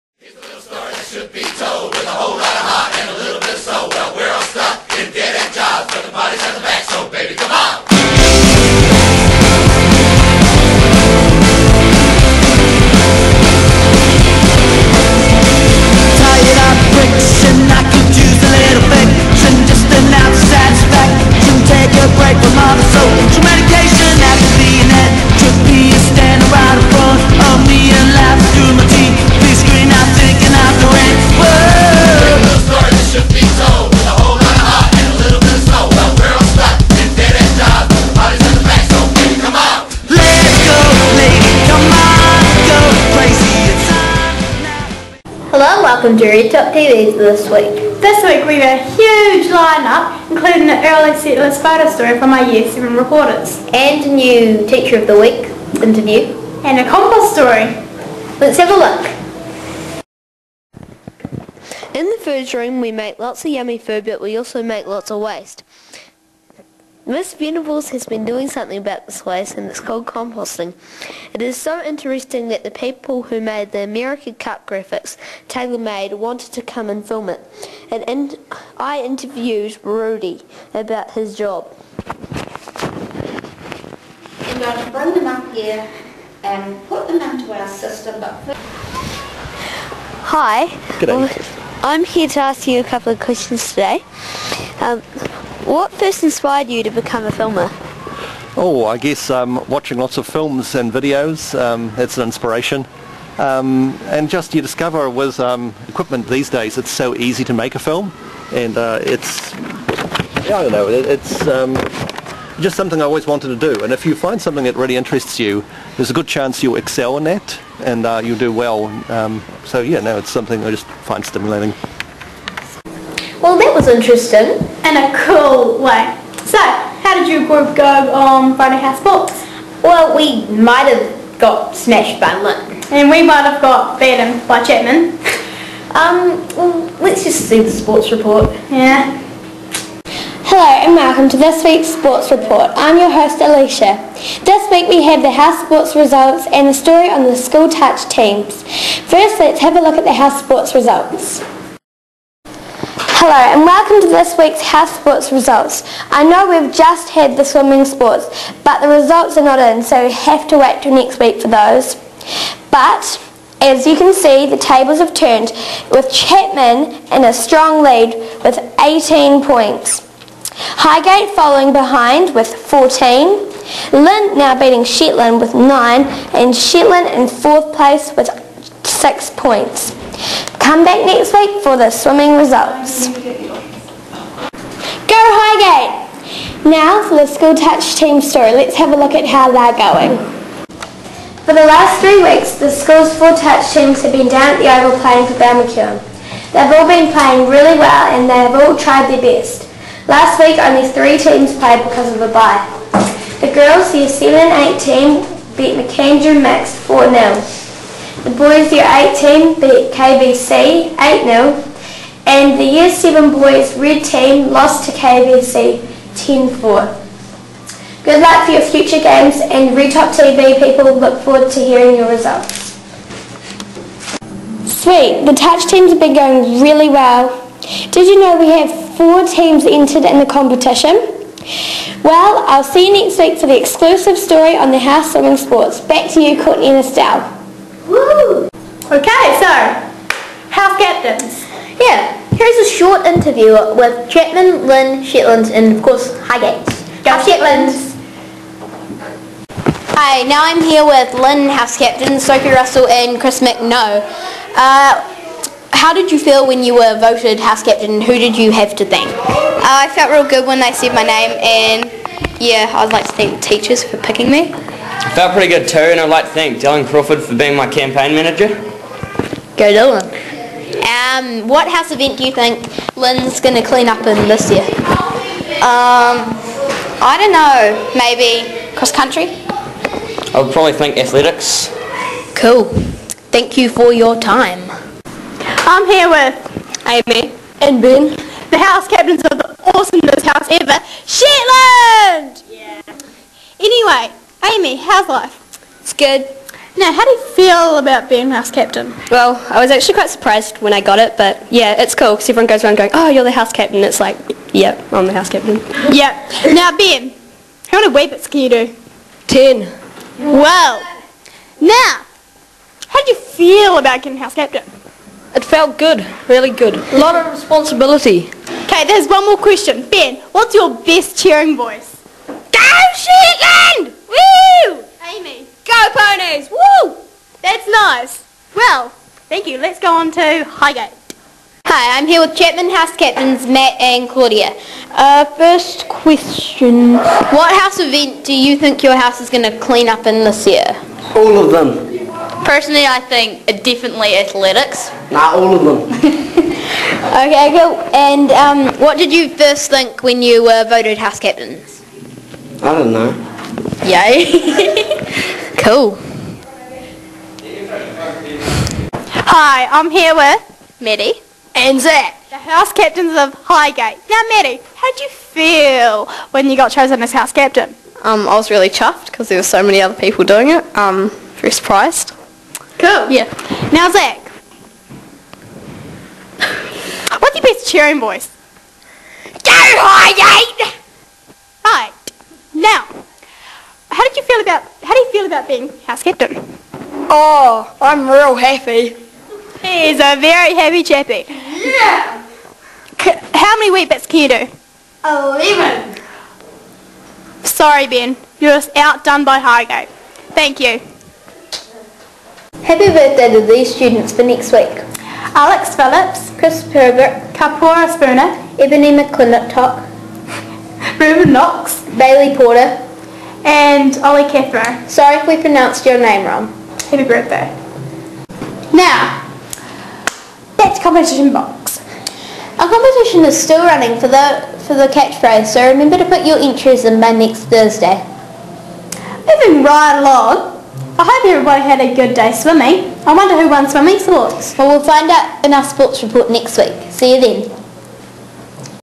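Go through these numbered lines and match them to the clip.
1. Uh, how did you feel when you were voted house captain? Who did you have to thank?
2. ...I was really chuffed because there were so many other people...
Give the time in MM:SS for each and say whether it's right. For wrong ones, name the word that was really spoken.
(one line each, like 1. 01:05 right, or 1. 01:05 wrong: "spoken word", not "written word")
1. 04:14 right
2. 06:08 right.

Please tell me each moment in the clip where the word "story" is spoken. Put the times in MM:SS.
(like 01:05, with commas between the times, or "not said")
00:51, 00:57, 02:26, 03:08, 03:54.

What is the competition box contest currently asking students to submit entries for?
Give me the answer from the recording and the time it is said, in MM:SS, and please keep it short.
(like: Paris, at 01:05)
The catchphrase, at 07:04.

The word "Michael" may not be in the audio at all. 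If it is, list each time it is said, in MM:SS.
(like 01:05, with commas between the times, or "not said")
not said.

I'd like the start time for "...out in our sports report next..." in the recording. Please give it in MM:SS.
07:15.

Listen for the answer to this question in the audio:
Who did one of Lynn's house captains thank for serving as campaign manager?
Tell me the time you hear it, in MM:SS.
04:26.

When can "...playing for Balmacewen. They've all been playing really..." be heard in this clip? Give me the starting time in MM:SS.
03:14.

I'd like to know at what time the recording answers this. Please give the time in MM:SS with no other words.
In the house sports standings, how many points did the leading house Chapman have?
02:48.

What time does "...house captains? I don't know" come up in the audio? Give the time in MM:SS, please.
05:50.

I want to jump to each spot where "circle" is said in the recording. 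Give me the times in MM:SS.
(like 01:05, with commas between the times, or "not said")
not said.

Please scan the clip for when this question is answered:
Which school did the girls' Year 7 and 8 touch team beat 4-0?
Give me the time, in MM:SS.
03:25.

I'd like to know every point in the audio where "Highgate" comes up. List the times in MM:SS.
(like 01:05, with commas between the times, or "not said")
02:50, 03:05, 04:06, 05:30, 06:03, 06:19, 06:39.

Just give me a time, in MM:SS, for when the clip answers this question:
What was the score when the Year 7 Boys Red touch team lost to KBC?
03:36.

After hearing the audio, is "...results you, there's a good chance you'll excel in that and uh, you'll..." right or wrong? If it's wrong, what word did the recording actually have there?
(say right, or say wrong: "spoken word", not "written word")
wrong: "interests", not "results".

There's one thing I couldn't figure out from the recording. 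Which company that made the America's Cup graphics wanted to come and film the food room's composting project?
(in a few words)
TaylorMade.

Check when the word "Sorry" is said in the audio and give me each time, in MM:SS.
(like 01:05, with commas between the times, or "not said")
06:37, 06:54.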